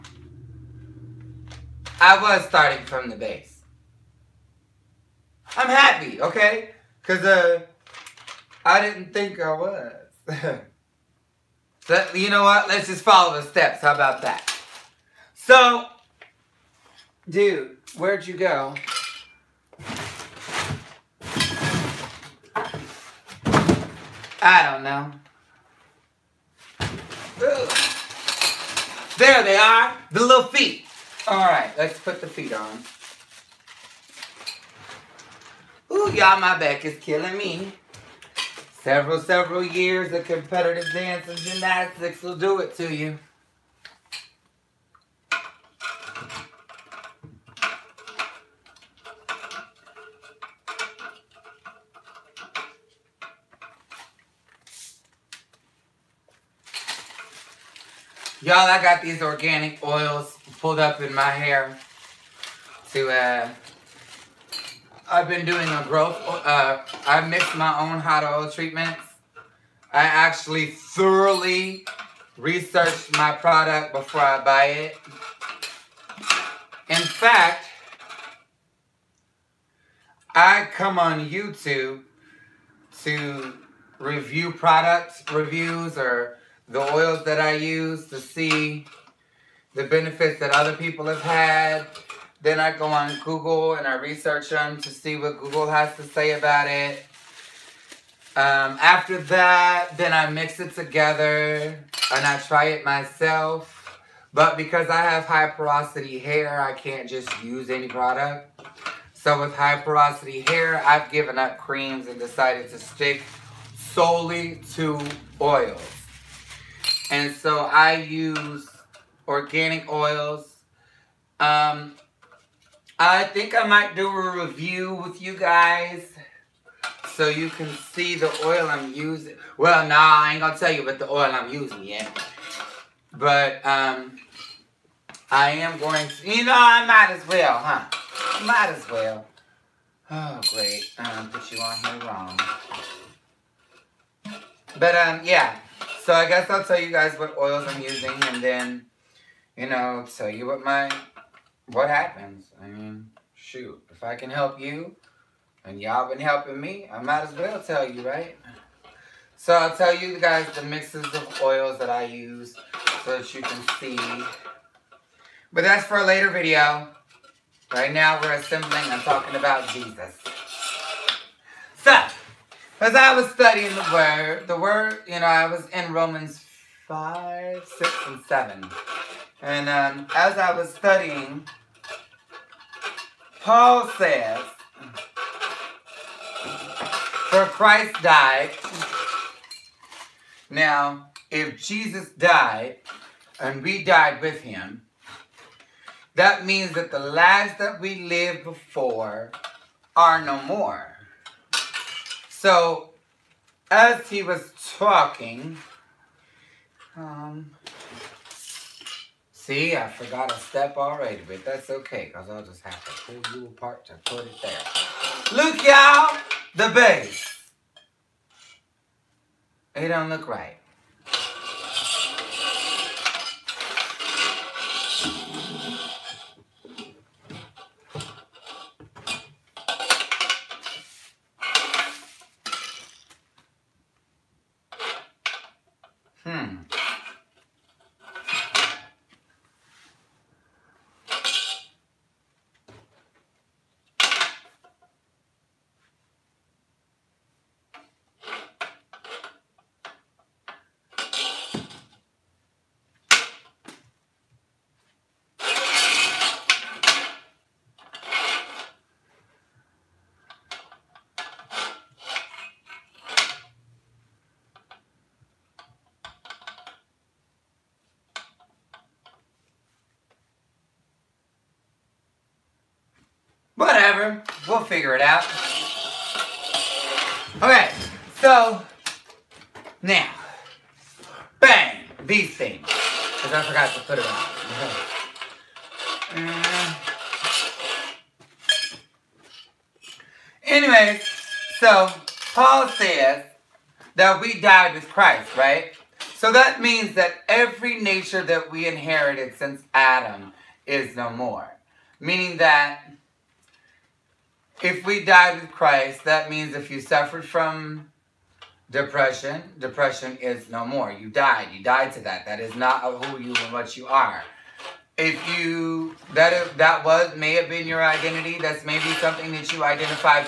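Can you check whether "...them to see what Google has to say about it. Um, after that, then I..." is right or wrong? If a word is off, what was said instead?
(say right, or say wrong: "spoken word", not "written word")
right.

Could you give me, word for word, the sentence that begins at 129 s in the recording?
Well, nah, I ain't gonna tell you about the oil I'm using yet.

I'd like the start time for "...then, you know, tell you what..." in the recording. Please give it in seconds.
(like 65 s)
148 s.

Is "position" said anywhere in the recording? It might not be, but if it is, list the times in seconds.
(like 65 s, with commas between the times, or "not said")
not said.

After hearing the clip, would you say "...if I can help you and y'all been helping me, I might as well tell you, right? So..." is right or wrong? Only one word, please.
right.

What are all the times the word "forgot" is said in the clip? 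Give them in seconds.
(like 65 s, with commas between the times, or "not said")
209 s, 283 s.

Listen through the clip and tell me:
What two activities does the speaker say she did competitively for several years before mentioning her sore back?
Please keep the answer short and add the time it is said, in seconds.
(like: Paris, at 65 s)
Dance and gymnastics, at 40 s.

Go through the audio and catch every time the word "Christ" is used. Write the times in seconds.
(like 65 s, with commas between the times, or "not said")
187 s, 294 s, 305 s.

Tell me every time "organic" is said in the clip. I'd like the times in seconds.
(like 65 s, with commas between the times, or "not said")
59 s, 119 s.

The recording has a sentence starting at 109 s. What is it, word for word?
So with high porosity hair, I've given up creams and decided to stick solely to oils.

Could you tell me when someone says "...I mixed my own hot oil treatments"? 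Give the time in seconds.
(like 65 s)
67 s.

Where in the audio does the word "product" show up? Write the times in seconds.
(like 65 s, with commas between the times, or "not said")
73 s, 84 s, 107 s.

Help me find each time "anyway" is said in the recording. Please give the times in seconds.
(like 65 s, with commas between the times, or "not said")
290 s.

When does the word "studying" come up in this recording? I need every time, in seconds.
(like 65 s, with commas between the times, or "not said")
173 s, 180 s.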